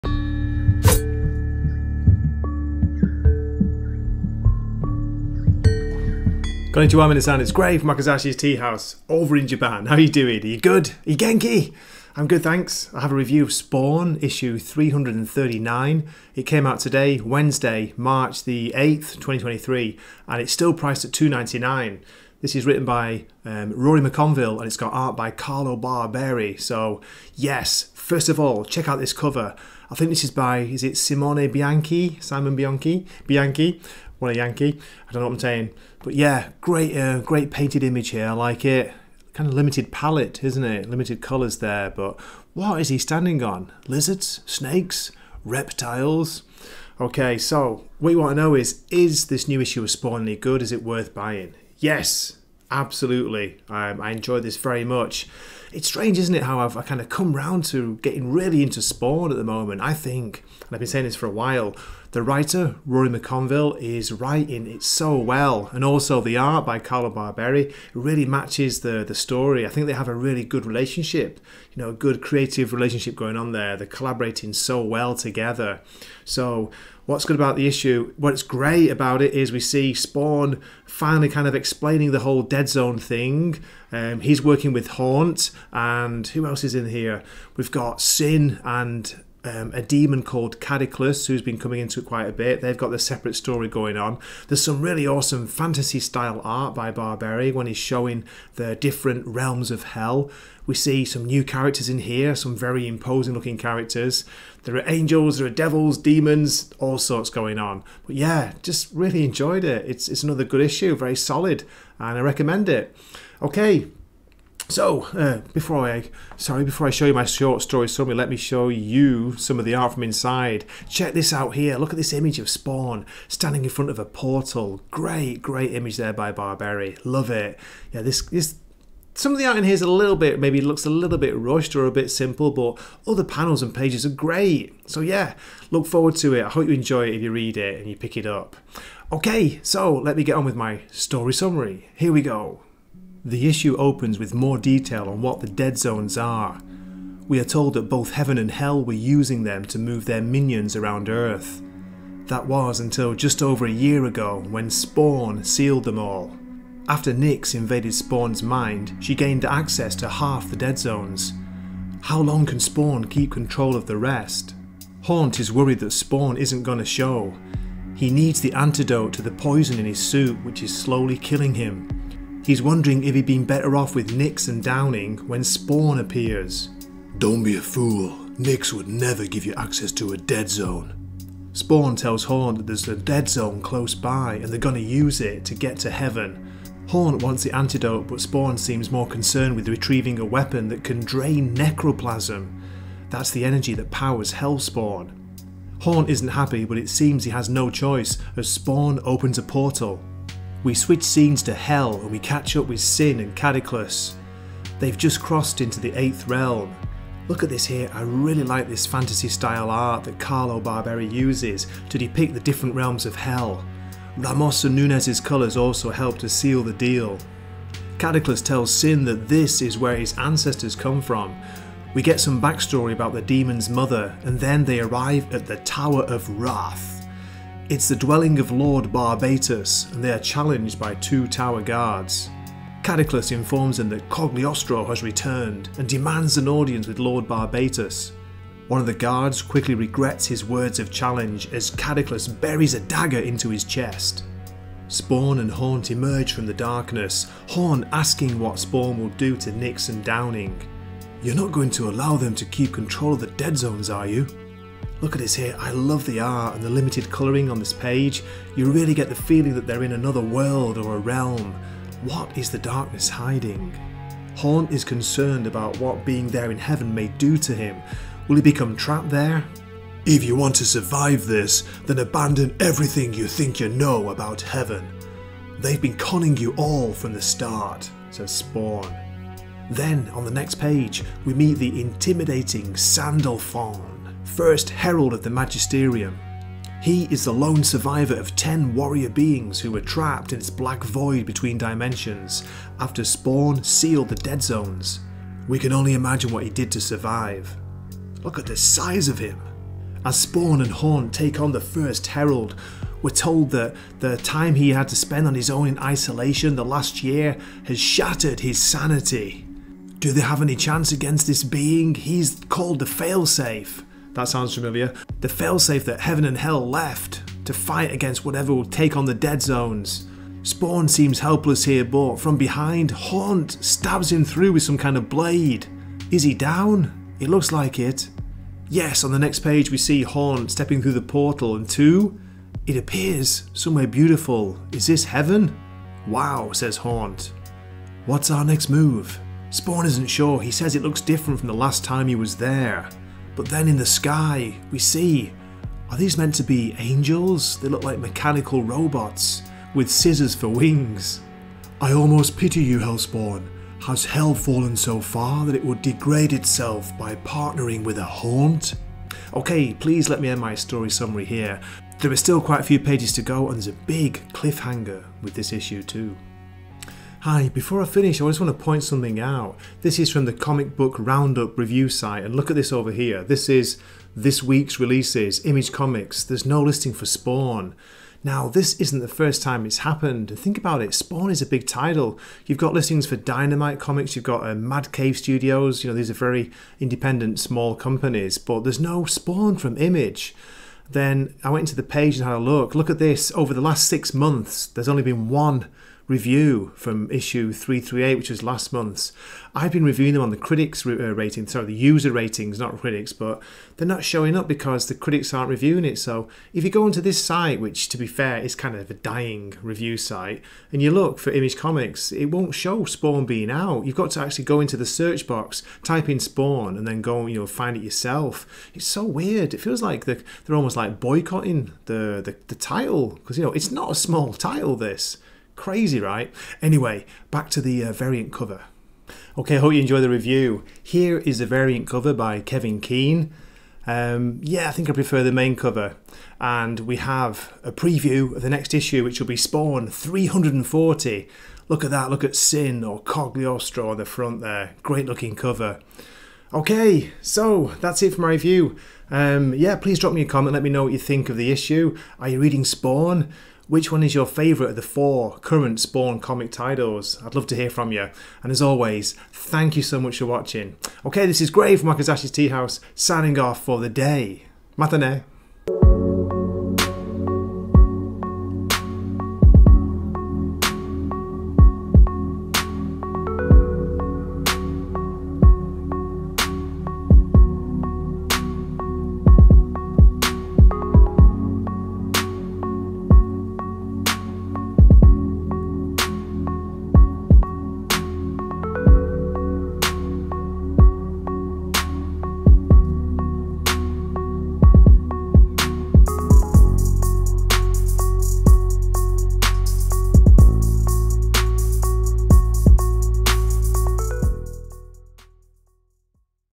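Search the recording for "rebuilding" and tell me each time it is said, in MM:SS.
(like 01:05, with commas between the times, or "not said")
not said.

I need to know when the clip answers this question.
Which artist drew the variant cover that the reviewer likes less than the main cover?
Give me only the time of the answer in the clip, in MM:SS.
07:12.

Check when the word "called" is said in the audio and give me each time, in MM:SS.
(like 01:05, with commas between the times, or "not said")
01:30, 05:12.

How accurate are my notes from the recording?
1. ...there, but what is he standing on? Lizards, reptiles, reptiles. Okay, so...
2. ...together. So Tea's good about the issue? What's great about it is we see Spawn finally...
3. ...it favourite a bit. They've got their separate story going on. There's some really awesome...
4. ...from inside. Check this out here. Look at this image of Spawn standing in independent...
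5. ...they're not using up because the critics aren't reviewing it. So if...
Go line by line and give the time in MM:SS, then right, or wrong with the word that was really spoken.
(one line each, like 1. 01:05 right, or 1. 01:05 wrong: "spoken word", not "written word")
1. 00:41 wrong: "snakes", not "reptiles"
2. 01:15 wrong: "What", not "Tea"
3. 01:31 wrong: "quite", not "favourite"
4. 01:59 wrong: "front", not "independent"
5. 06:43 wrong: "showing", not "using".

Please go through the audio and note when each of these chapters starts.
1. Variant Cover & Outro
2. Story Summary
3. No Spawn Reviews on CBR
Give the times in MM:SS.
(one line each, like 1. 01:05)
1. 07:09
2. 02:22
3. 06:07.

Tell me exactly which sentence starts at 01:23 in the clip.
Um, he's working with Haunt, and who else is in here?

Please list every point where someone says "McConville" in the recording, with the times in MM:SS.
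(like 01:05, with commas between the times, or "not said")
00:23, 01:03.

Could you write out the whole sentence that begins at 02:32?
That was until just over a year ago when Spawn sealed them all.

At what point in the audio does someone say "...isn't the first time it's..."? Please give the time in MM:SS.
06:18.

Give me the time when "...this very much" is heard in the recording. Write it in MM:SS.
00:54.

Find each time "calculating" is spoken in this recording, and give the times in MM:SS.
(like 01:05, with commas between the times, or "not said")
not said.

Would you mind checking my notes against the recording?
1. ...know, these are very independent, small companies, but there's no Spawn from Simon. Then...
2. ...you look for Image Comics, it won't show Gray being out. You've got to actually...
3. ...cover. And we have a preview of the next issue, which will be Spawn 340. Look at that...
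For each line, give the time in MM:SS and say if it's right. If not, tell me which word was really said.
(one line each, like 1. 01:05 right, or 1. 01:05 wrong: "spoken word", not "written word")
1. 06:25 wrong: "Image", not "Simon"
2. 06:50 wrong: "Spawn", not "Gray"
3. 07:15 right.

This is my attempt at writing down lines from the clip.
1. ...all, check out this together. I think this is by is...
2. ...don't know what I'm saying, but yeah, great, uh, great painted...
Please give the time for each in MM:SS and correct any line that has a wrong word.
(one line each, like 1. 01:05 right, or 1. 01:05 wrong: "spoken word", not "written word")
1. 00:28 wrong: "cover", not "together"
2. 00:35 right.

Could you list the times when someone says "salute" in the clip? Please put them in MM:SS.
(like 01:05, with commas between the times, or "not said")
not said.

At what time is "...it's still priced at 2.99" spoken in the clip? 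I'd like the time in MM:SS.
00:20.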